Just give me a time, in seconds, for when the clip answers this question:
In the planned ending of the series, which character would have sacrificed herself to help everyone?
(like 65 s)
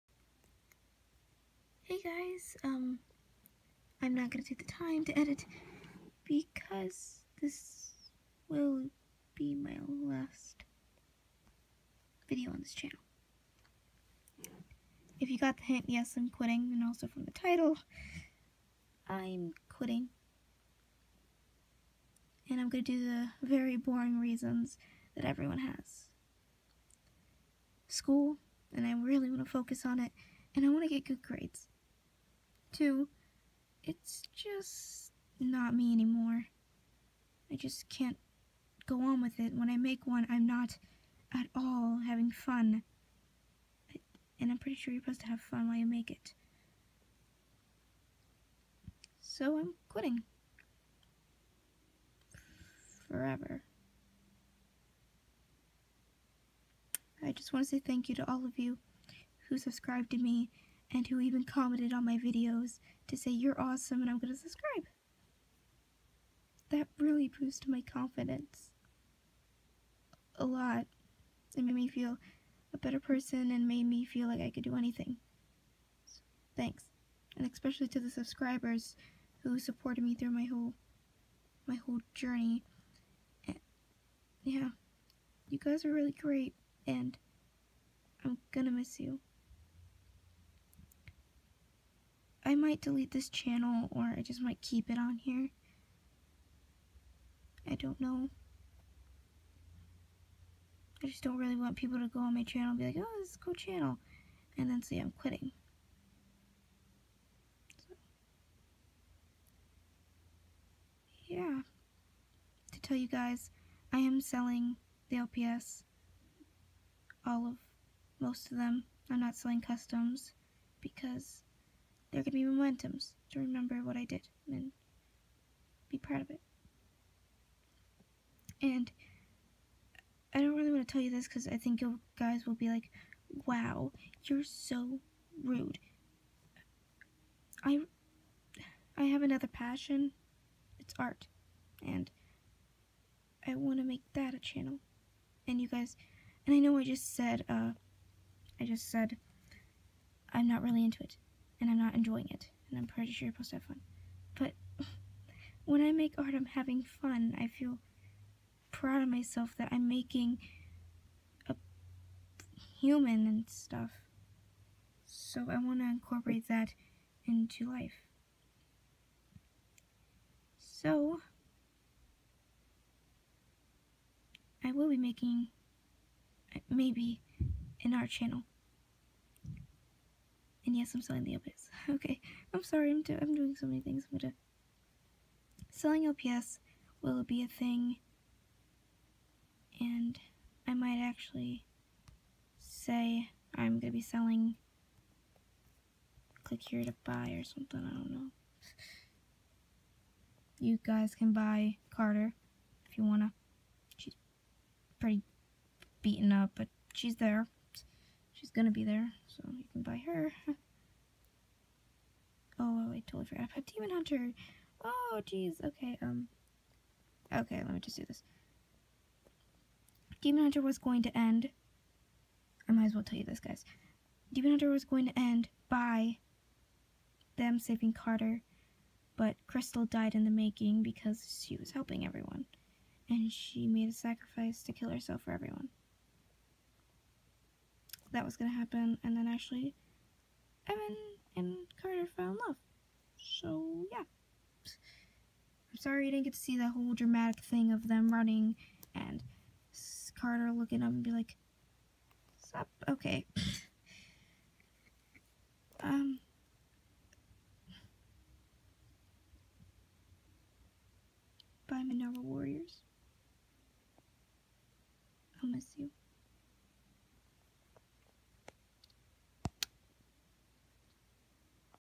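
229 s.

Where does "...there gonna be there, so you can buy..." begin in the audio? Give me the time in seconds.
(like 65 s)
207 s.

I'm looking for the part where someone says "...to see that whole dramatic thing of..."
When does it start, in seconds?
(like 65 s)
246 s.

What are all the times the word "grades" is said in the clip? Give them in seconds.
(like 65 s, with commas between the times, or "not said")
31 s.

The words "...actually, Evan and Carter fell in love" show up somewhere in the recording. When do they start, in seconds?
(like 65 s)
239 s.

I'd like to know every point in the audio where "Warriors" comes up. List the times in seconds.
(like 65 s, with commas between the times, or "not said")
262 s.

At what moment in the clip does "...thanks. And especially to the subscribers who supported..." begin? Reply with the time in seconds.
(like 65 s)
76 s.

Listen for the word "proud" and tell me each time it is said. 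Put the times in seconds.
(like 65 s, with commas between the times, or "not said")
125 s, 158 s.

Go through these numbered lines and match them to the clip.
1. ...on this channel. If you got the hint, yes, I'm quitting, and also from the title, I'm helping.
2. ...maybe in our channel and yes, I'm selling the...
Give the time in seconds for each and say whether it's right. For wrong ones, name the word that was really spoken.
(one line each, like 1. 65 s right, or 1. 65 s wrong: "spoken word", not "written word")
1. 12 s wrong: "quitting", not "helping"
2. 176 s right.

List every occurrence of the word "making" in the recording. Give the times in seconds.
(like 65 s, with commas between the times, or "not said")
159 s, 174 s, 230 s.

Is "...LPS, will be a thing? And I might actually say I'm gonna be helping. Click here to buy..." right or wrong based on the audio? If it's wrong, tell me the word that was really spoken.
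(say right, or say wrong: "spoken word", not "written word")
wrong: "selling", not "helping".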